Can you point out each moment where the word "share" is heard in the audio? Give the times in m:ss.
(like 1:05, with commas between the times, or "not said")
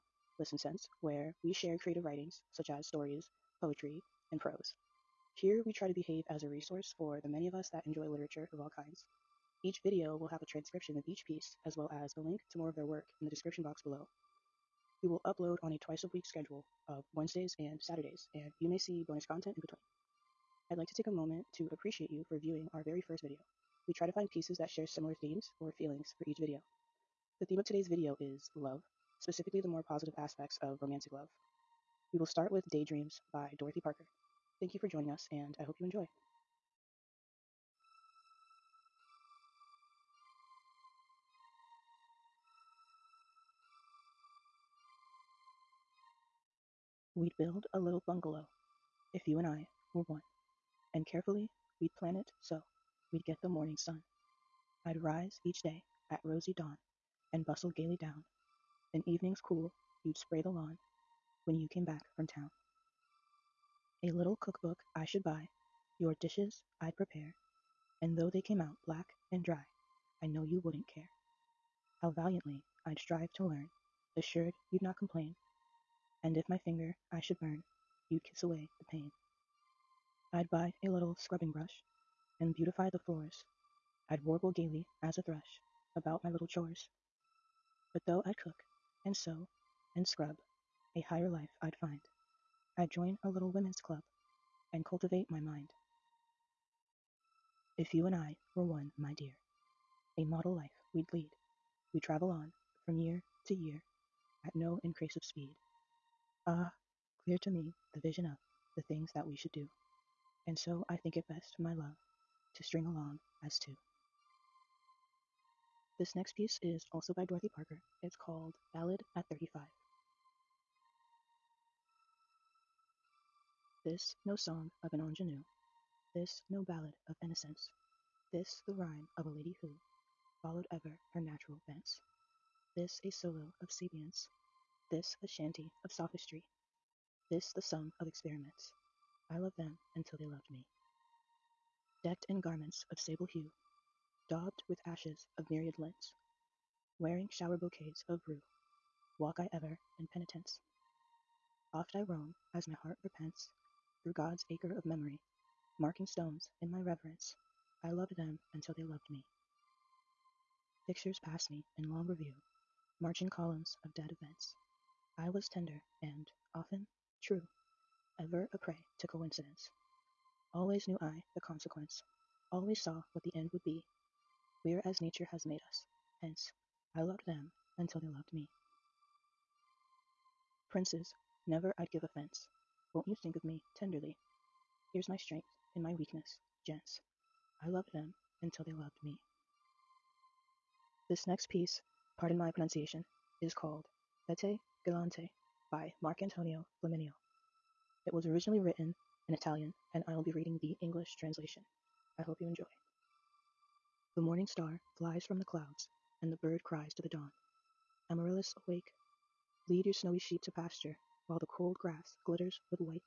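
0:01, 0:24.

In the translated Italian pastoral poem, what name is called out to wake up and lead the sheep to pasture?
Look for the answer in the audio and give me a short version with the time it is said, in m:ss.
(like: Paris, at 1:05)
Amaryllis, at 3:28.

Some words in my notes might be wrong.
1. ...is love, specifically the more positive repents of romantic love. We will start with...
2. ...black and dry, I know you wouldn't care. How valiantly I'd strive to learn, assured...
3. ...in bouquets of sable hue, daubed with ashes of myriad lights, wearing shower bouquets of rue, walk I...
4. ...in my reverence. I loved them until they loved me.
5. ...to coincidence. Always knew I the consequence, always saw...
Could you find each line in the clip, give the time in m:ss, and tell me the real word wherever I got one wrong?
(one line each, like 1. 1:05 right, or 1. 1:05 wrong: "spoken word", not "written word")
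1. 0:28 wrong: "aspects", not "repents"
2. 1:08 right
3. 2:22 wrong: "garments", not "bouquets"
4. 2:36 right
5. 2:49 right.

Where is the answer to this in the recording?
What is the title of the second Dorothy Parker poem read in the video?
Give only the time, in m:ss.
1:58.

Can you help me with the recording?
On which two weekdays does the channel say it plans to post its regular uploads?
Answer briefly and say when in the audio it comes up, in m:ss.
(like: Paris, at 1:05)
Wednesdays and Saturdays, at 0:17.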